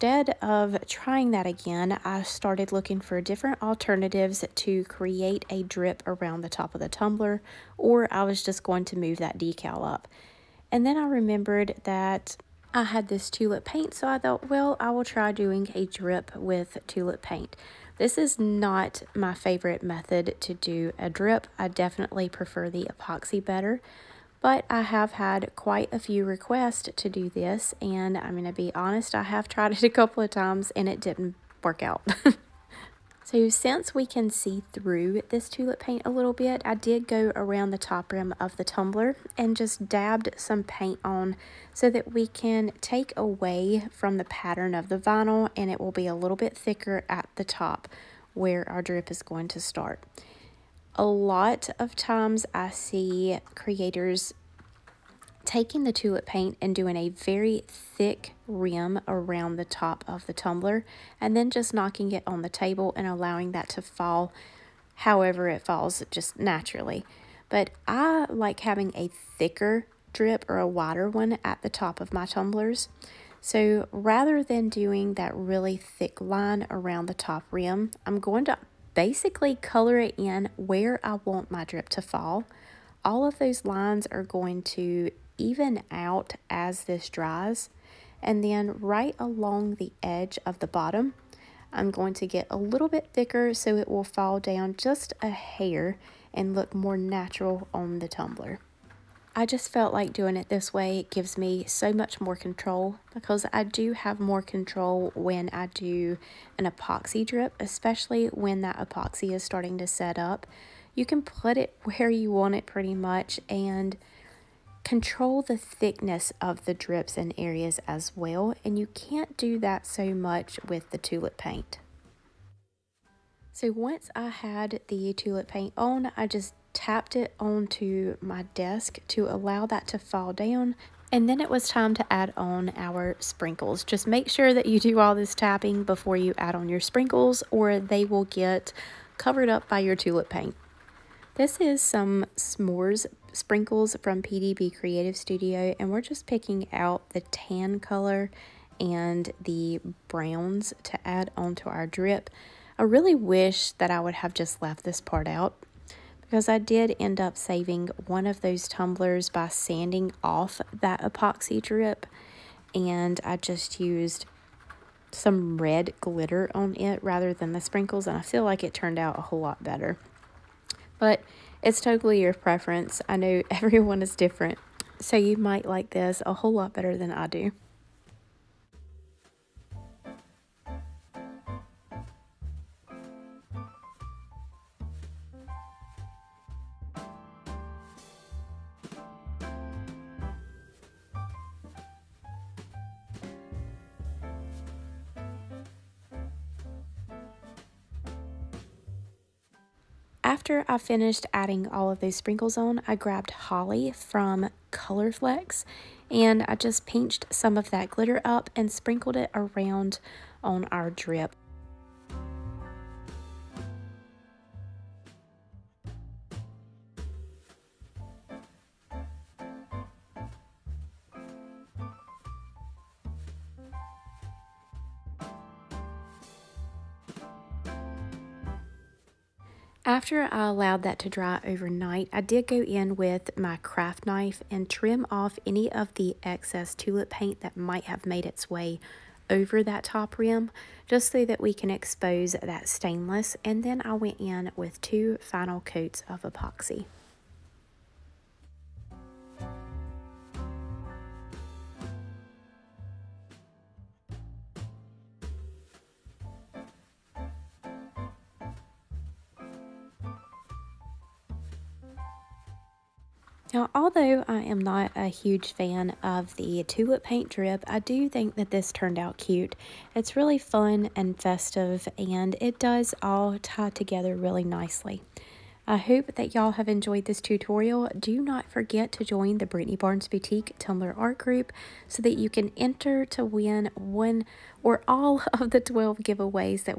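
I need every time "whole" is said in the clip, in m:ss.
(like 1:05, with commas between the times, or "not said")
2:49, 2:56.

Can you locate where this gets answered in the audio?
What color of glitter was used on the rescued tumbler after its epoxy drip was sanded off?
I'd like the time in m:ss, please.
2:45.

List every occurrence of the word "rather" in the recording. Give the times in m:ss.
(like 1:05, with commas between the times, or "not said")
1:13, 2:47.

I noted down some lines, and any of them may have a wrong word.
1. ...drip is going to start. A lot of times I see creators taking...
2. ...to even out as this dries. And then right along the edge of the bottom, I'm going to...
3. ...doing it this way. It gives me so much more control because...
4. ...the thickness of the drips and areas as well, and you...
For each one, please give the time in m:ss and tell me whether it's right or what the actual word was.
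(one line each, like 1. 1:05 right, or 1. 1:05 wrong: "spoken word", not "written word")
1. 0:48 right
2. 1:24 right
3. 1:40 right
4. 1:55 right.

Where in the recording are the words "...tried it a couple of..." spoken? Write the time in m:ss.
0:29.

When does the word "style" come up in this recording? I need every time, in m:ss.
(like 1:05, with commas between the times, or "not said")
not said.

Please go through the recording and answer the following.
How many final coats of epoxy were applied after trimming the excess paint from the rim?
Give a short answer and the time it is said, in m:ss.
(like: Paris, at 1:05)
2, at 4:04.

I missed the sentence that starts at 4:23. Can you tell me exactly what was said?
Now, although I am not a huge fan of the tulip paint drip, I do think that this turned out cute.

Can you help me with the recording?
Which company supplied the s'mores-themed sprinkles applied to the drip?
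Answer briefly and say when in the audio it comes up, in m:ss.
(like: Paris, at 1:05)
PDB Creative Studio, at 2:24.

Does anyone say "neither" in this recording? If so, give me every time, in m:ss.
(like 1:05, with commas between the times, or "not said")
not said.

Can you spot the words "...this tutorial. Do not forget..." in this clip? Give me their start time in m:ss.
4:37.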